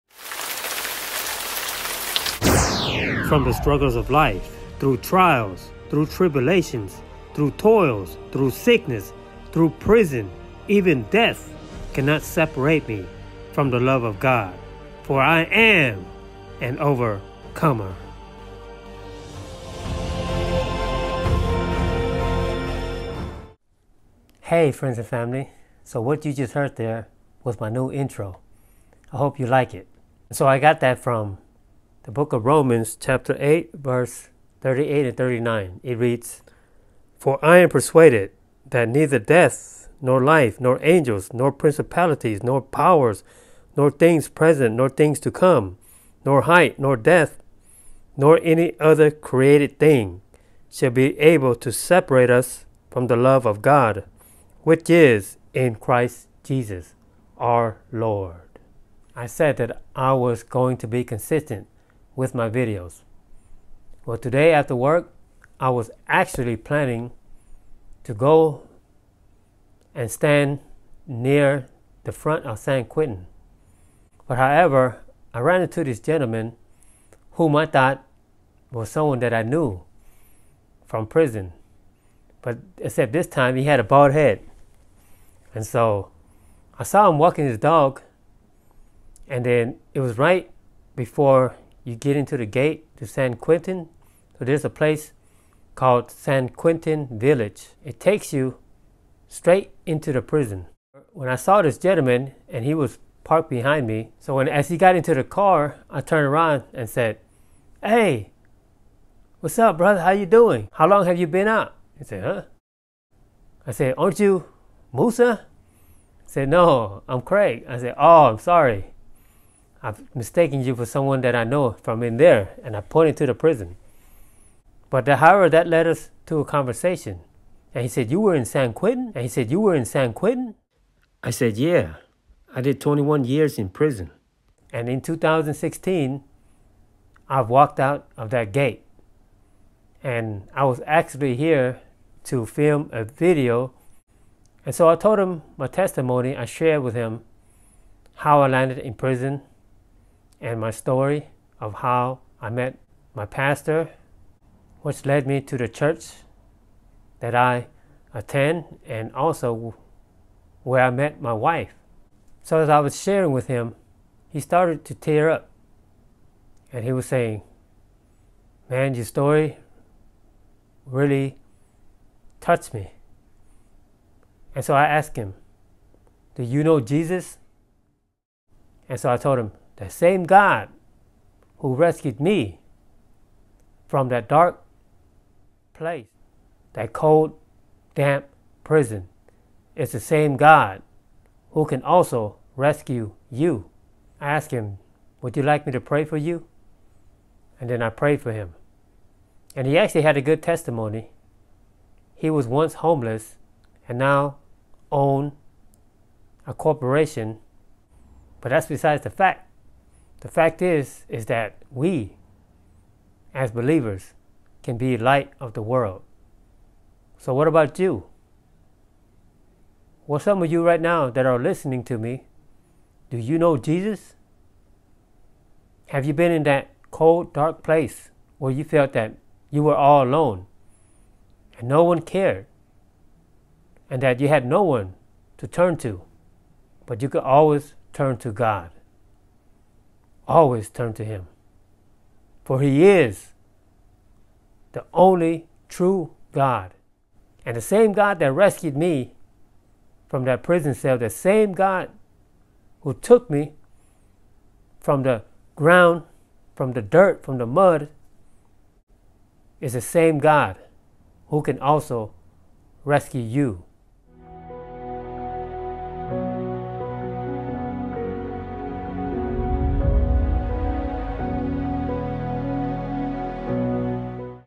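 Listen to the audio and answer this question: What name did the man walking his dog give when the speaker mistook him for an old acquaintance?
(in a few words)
Craig.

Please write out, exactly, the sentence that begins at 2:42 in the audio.
So as I was sharing with him, he started to tear up.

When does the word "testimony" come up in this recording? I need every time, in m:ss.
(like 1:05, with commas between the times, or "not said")
2:25, 3:20.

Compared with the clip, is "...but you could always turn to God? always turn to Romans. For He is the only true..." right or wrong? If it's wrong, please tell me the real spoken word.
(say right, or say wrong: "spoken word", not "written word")
wrong: "Him", not "Romans".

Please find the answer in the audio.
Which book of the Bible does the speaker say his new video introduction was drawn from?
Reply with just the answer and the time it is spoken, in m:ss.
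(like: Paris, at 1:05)
Romans, at 0:32.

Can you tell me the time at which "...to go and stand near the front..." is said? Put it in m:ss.
1:08.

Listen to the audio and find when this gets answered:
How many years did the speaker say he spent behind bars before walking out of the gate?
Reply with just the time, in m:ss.
2:12.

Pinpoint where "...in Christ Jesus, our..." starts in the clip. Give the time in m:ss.
0:55.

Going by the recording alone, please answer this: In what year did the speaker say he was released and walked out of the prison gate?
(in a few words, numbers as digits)
2016.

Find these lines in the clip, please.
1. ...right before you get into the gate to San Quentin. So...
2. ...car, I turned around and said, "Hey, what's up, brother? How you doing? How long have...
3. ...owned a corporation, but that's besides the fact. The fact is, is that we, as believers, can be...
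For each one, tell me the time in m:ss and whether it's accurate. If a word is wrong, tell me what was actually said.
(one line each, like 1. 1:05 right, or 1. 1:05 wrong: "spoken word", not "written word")
1. 1:30 right
2. 1:45 right
3. 3:24 right.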